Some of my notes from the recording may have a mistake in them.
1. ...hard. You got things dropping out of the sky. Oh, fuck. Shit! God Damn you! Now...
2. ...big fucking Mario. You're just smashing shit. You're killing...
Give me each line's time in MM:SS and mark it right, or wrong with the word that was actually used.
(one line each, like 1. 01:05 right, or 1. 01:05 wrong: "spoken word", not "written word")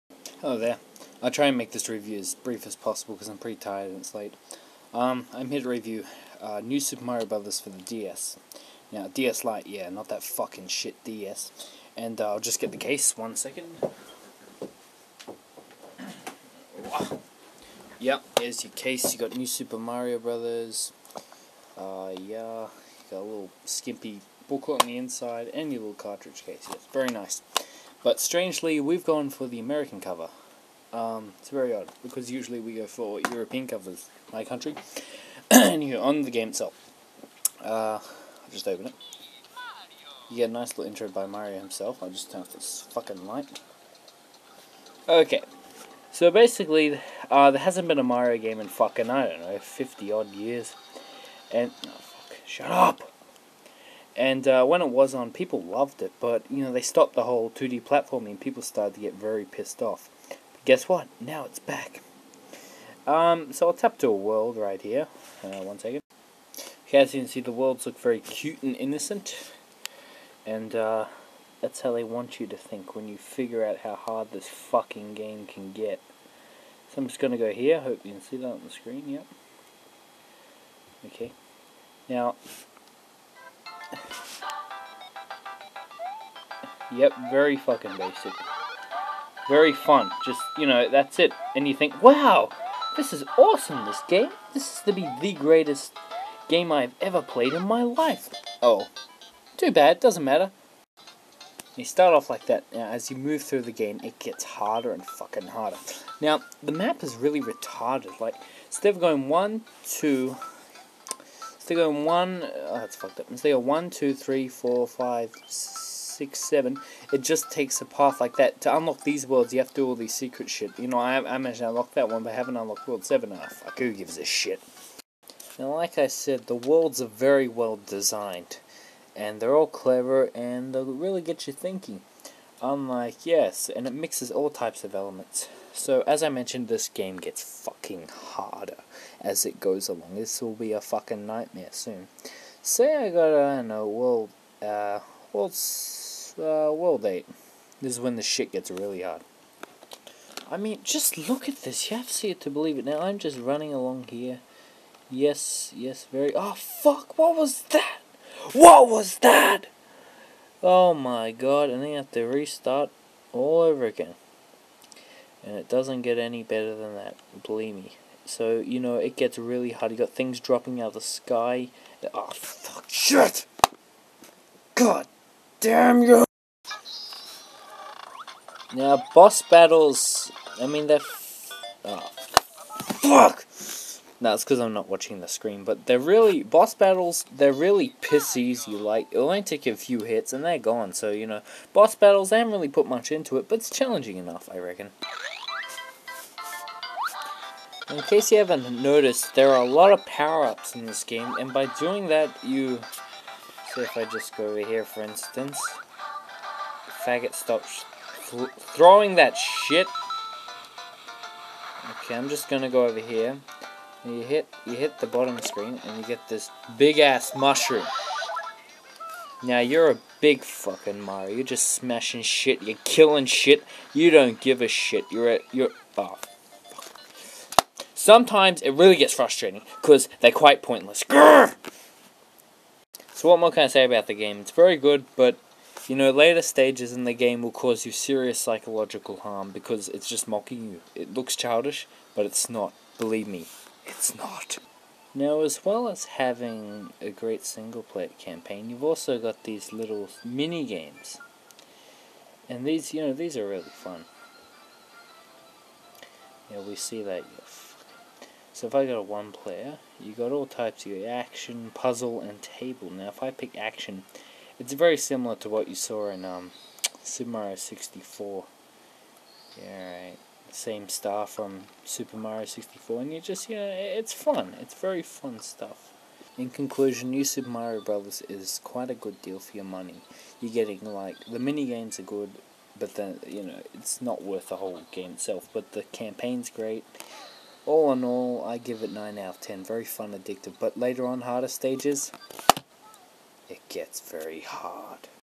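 1. 02:49 right
2. 03:40 right.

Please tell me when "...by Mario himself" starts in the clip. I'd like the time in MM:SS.
00:41.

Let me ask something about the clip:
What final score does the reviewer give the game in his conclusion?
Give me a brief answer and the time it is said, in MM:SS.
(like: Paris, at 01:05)
9 out of 10, at 04:48.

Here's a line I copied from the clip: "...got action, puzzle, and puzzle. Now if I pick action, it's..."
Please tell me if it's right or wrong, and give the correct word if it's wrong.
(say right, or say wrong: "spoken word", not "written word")
wrong: "table", not "puzzle".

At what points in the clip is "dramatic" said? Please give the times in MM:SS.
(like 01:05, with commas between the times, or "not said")
not said.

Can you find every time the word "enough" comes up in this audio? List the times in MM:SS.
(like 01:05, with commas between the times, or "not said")
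02:03, 03:14.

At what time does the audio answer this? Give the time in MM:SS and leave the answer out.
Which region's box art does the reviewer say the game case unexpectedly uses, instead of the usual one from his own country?
00:29.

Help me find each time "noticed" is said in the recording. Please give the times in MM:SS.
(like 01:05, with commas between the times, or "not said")
03:18.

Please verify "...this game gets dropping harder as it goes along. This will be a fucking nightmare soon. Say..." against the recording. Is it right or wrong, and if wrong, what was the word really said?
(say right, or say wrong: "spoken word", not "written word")
wrong: "fucking", not "dropping".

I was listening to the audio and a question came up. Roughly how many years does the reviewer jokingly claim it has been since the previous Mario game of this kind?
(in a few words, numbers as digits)
50.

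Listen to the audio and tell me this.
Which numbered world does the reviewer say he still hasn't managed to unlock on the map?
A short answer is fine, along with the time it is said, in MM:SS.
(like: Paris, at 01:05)
World 7, at 02:02.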